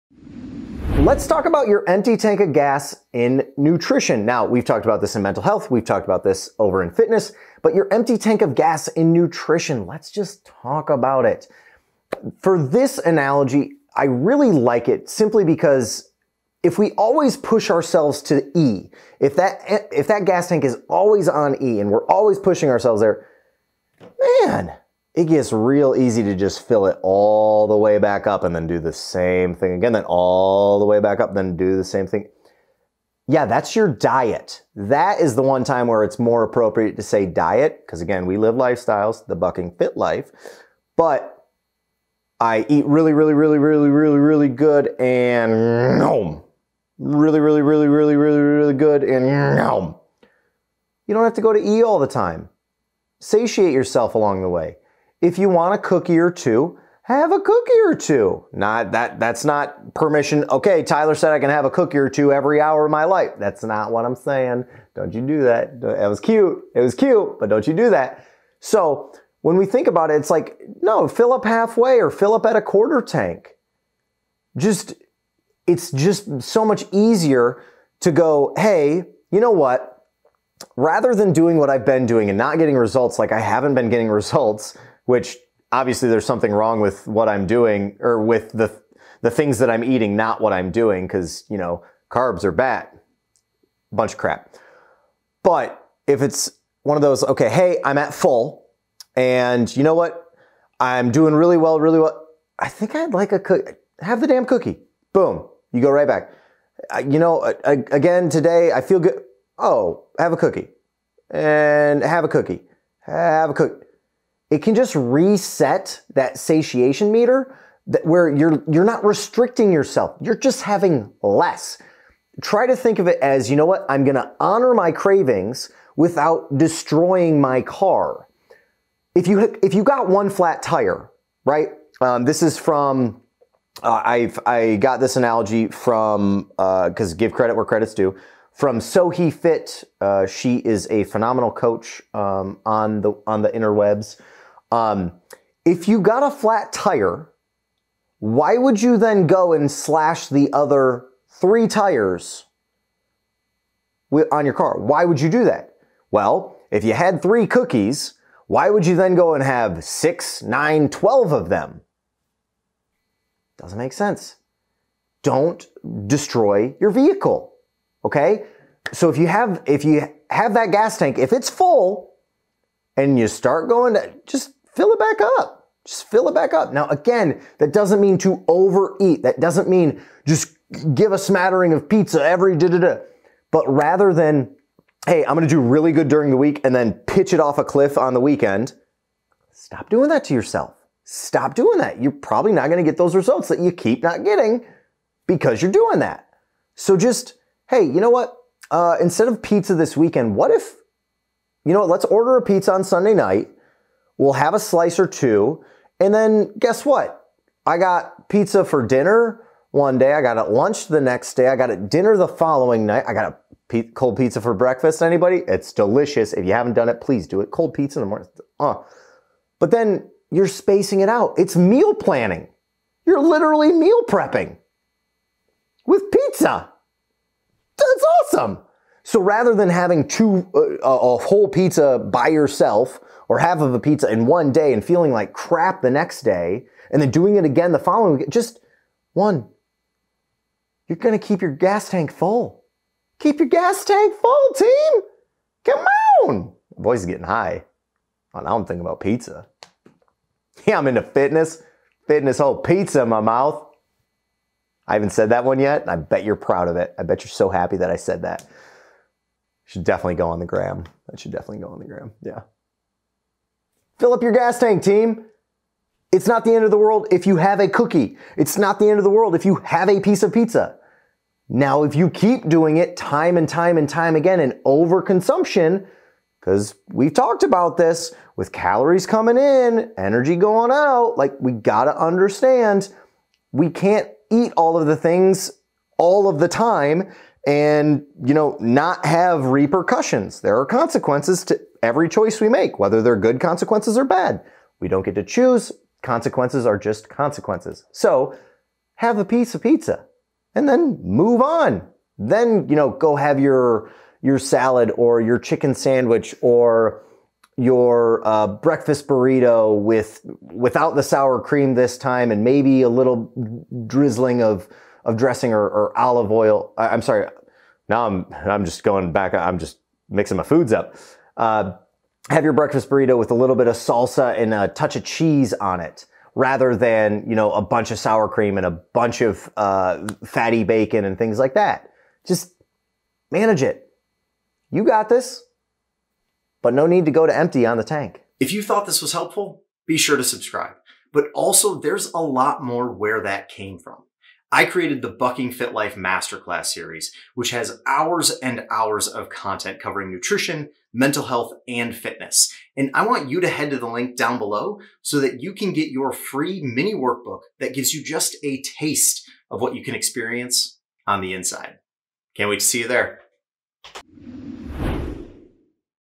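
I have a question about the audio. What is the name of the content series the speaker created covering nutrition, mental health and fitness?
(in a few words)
Bucking Fit Life Masterclass.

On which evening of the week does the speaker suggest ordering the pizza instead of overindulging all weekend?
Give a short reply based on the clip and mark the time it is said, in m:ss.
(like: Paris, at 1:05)
Sunday night, at 3:22.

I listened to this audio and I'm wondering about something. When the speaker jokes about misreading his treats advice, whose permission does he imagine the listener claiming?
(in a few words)
Tyler.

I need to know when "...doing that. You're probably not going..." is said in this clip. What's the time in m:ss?
3:11.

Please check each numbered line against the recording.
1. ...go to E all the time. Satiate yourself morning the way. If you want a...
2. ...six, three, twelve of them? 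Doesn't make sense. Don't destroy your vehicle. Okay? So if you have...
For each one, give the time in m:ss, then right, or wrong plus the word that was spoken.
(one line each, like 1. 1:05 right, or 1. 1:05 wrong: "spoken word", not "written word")
1. 0:51 wrong: "along", not "morning"
2. 2:39 wrong: "nine", not "three".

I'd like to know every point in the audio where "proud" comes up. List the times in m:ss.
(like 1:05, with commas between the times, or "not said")
4:16.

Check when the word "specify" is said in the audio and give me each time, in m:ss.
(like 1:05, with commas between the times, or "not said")
not said.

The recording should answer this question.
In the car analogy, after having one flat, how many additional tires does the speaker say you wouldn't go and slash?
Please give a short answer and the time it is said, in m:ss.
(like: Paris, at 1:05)
3, at 2:30.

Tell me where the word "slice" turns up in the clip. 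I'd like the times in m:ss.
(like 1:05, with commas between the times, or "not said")
3:24.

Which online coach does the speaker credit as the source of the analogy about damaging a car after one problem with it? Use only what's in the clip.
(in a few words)
he Fit.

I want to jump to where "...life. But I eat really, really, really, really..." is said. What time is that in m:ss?
0:39.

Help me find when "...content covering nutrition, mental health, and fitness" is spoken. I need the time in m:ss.
5:49.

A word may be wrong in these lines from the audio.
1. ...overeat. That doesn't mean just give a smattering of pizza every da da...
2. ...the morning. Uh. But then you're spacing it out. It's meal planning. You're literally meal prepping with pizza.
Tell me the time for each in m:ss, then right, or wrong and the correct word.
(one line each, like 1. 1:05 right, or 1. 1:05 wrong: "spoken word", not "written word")
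1. 2:58 right
2. 3:38 right.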